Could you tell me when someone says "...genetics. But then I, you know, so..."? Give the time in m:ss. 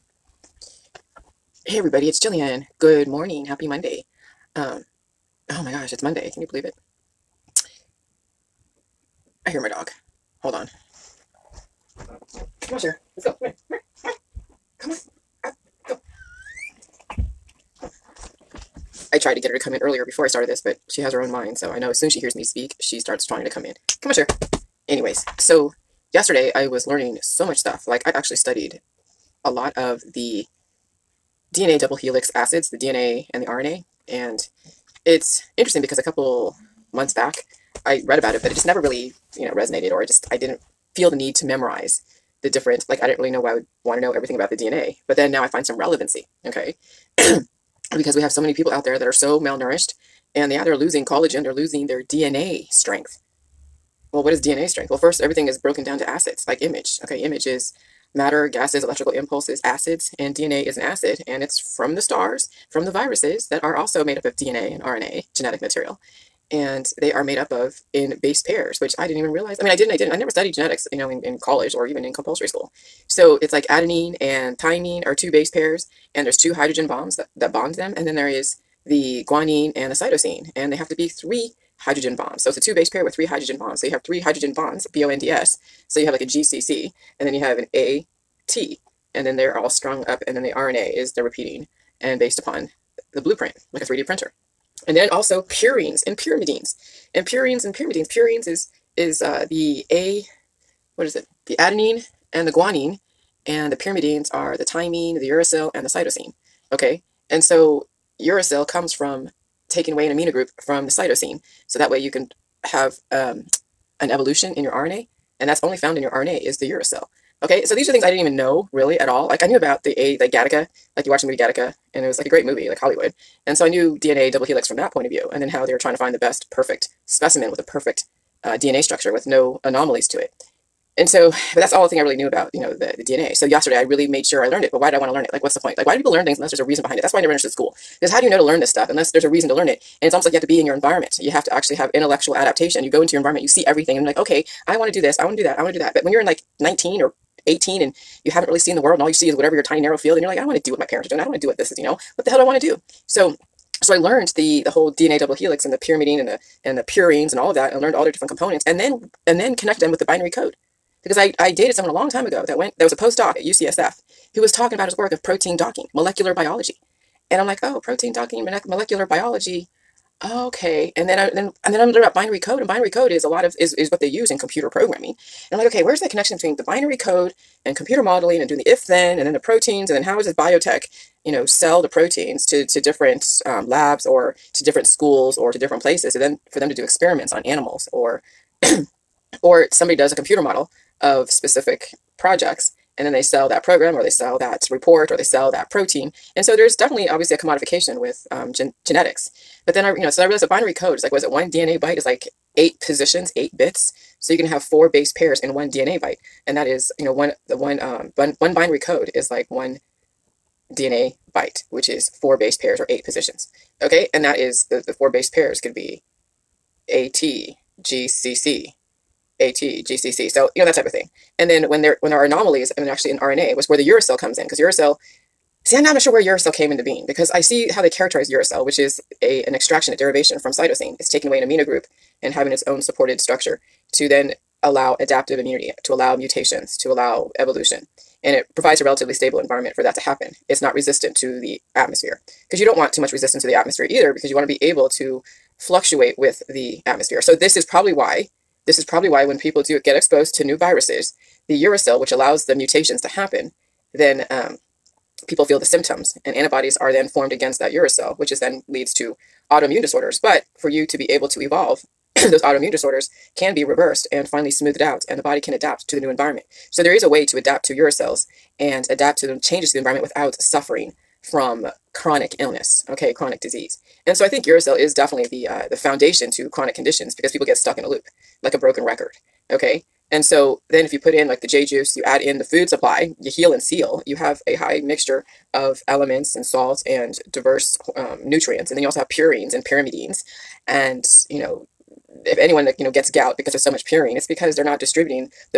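3:18.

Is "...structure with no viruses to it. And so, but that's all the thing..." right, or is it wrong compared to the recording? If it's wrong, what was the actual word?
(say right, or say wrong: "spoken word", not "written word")
wrong: "anomalies", not "viruses".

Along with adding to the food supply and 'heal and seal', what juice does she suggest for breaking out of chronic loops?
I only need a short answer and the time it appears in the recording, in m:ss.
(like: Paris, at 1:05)
J juice, at 4:41.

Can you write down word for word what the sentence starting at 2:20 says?
And it's almost like you have to be in your environment.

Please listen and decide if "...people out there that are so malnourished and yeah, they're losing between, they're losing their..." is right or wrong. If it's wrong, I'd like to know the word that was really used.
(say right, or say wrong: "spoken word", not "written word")
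wrong: "collagen", not "between".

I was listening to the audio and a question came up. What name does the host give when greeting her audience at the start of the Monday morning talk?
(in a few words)
Jillian.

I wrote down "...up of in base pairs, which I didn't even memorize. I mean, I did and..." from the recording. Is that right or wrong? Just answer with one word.
wrong.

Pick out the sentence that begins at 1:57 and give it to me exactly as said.
Okay, so these are things I didn't even know really at all.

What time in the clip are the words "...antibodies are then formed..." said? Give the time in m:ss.
4:16.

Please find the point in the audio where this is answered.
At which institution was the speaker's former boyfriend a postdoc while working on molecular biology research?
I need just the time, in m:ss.
2:43.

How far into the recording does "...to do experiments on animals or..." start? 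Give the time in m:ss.
3:06.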